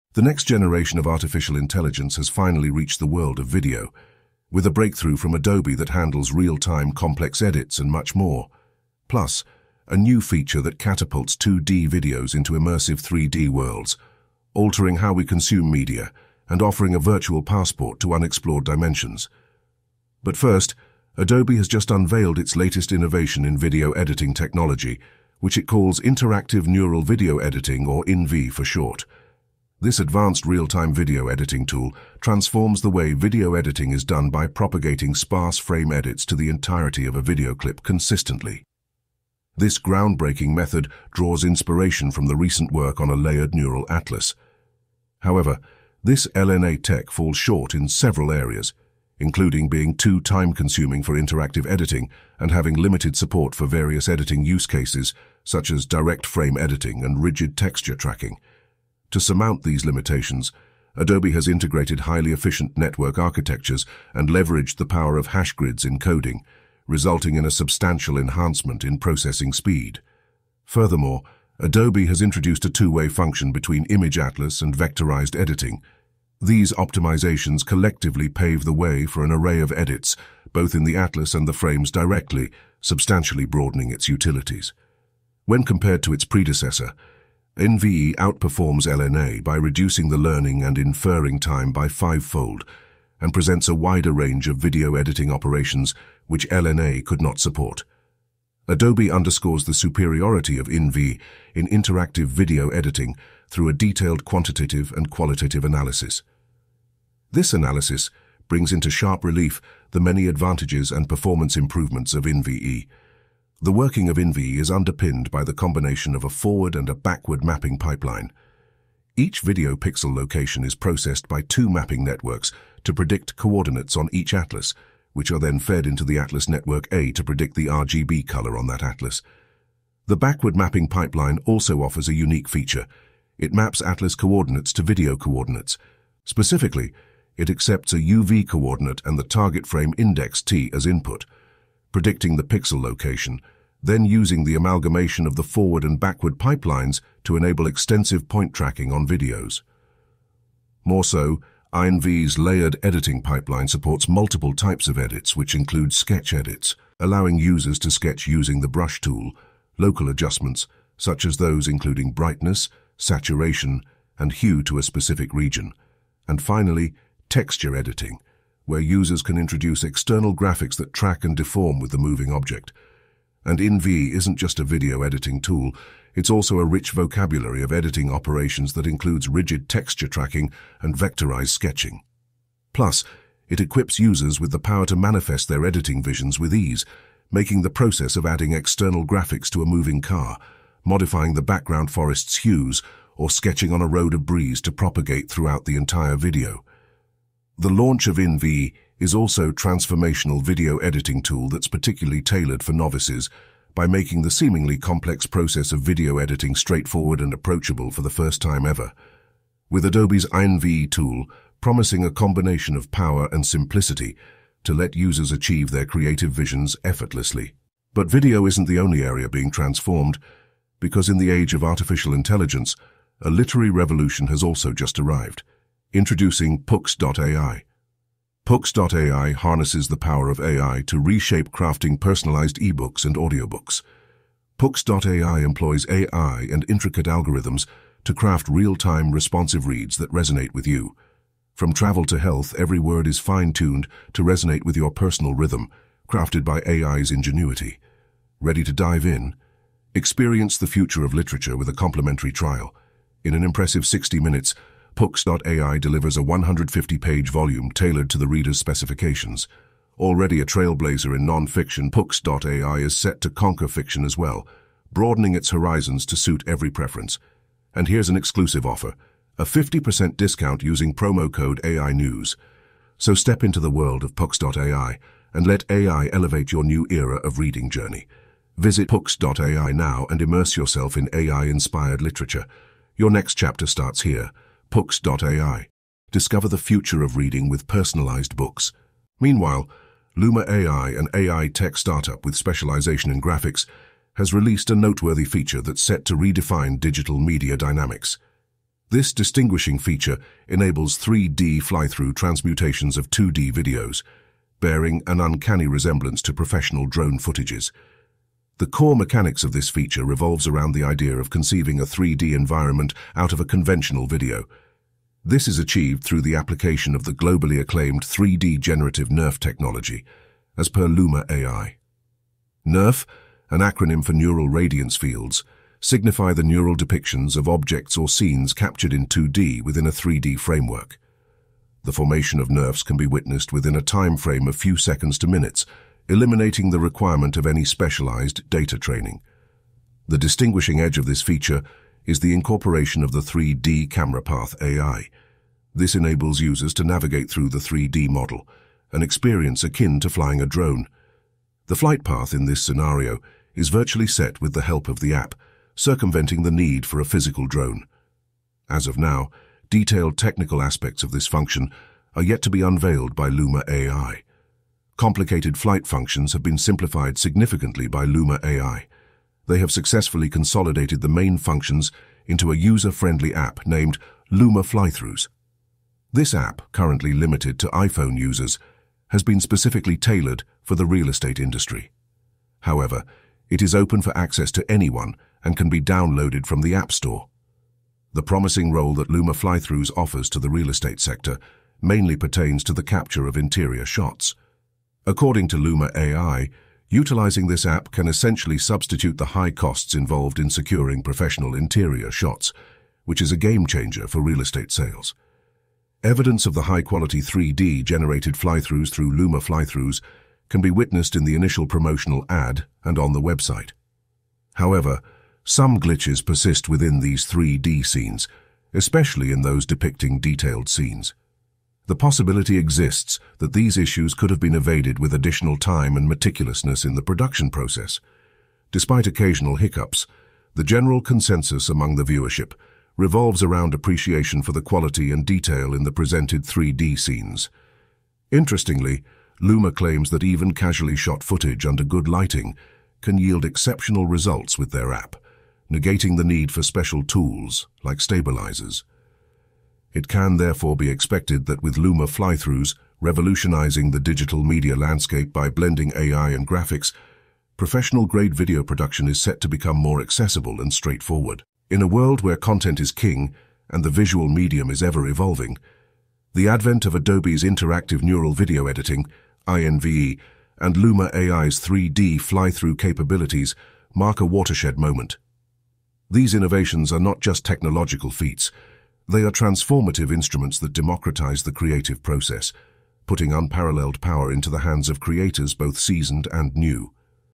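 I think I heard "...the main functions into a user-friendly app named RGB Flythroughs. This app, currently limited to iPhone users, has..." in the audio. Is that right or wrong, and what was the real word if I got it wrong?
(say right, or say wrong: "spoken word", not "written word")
wrong: "Luma", not "RGB".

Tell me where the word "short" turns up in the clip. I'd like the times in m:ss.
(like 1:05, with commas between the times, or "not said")
0:28, 0:47.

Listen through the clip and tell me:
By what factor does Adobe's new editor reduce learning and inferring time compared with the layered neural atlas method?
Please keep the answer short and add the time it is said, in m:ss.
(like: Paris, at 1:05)
fivefold, at 1:31.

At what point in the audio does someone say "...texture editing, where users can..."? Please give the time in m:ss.
2:47.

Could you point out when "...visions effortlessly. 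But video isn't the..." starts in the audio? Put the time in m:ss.
3:36.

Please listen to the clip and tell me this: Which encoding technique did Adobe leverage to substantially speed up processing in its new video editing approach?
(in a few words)
hash grids encoding.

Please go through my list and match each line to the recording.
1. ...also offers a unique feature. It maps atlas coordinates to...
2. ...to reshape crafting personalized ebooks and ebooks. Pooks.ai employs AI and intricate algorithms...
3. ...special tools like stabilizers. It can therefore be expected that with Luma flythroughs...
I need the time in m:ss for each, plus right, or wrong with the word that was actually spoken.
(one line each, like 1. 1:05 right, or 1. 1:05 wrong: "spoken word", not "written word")
1. 2:11 right
2. 3:50 wrong: "audiobooks", not "ebooks"
3. 7:26 right.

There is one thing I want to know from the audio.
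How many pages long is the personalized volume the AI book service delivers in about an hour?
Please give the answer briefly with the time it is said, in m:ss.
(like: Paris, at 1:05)
150, at 4:16.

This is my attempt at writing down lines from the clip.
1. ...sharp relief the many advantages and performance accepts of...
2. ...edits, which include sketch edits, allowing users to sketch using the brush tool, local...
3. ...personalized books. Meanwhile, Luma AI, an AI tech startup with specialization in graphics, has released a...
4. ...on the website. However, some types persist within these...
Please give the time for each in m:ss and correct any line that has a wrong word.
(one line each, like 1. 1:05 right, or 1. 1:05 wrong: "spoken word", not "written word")
1. 1:48 wrong: "improvements", not "accepts"
2. 2:34 right
3. 4:47 right
4. 6:52 wrong: "glitches", not "types".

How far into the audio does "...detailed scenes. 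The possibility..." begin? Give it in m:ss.
7:00.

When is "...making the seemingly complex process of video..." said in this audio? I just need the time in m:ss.
3:23.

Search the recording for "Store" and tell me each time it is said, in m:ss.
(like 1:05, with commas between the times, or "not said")
6:26.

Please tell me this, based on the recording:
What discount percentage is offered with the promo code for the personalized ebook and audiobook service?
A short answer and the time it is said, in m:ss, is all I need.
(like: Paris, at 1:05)
50%, at 4:29.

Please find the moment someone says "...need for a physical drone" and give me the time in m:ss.
5:56.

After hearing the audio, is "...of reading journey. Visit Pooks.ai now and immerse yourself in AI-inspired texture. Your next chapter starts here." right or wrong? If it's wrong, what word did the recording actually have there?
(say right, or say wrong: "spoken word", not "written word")
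wrong: "literature", not "texture".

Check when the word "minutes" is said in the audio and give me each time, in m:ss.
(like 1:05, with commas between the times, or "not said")
4:14, 5:35.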